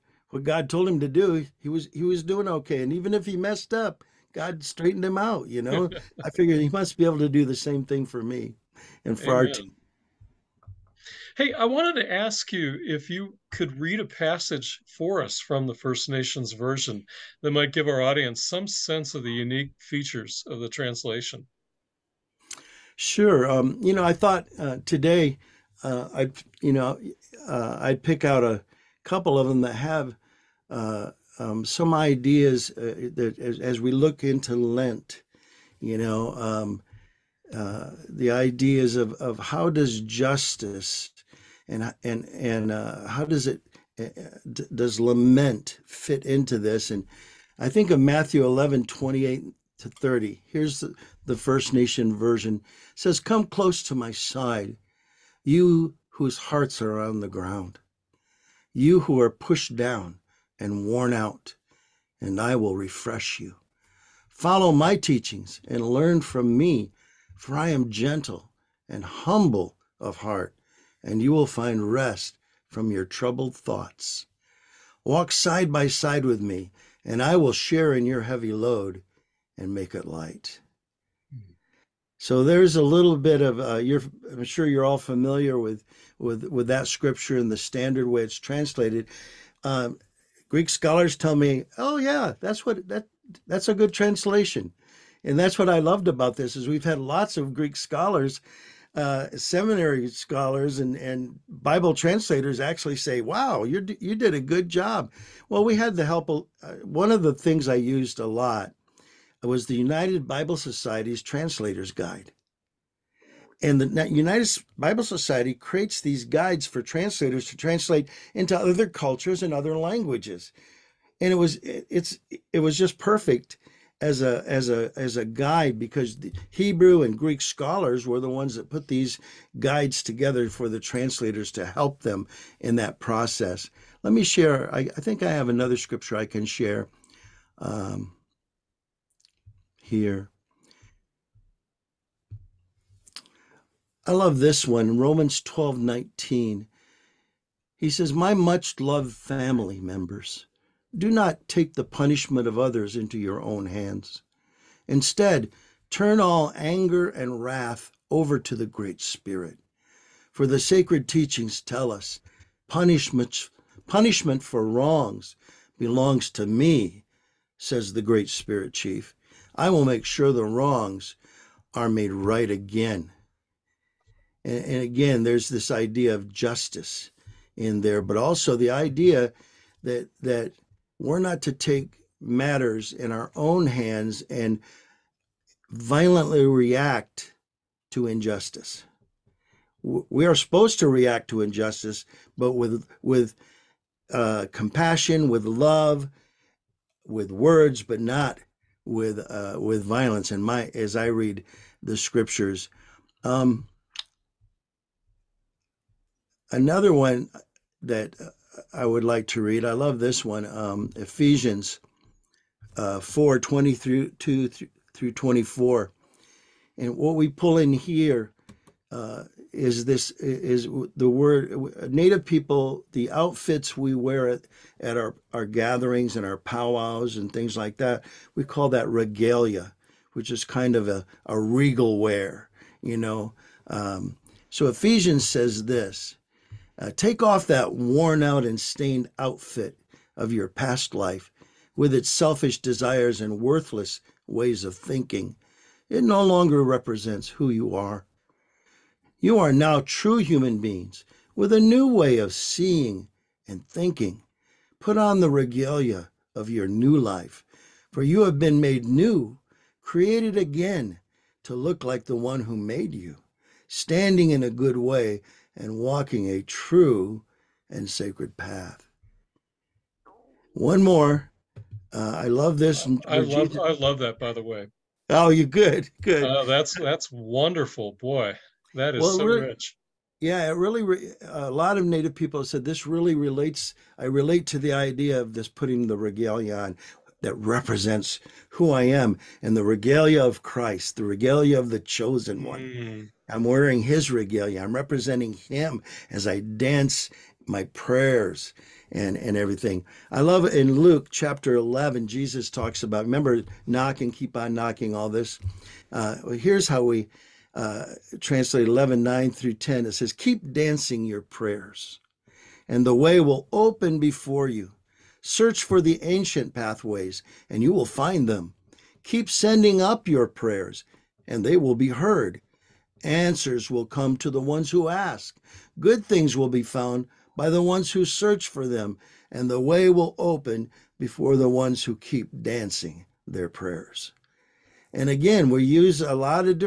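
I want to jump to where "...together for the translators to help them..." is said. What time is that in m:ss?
2:10.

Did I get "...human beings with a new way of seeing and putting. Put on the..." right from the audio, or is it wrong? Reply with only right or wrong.
wrong.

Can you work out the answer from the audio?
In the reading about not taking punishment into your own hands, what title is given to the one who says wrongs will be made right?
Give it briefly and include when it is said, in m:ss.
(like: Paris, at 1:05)
Great Spirit Chief, at 2:48.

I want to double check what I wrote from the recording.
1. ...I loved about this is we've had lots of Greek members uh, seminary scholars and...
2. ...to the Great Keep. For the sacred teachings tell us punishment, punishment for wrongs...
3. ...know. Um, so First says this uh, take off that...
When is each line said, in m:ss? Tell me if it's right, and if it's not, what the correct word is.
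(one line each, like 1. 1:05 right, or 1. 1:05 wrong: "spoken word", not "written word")
1. 1:35 wrong: "scholars", not "members"
2. 2:38 wrong: "Spirit", not "Keep"
3. 3:52 wrong: "Ephesians", not "First".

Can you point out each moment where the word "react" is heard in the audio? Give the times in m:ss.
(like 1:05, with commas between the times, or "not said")
3:06, 3:10.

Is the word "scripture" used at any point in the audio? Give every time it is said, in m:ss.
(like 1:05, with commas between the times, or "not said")
1:26, 2:15, 3:21.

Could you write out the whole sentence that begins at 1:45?
Well, we had the help of uh, one of the things I used a lot was the United Bible Society's Translator's Guide.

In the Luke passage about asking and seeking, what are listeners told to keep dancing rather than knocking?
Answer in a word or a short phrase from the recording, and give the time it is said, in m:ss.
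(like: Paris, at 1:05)
their prayers, at 5:10.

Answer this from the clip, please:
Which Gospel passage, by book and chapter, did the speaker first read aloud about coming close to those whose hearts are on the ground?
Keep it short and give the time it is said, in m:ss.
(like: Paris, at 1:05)
Matthew 11, at 0:47.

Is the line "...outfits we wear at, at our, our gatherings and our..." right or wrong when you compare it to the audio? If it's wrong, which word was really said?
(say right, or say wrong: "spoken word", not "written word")
right.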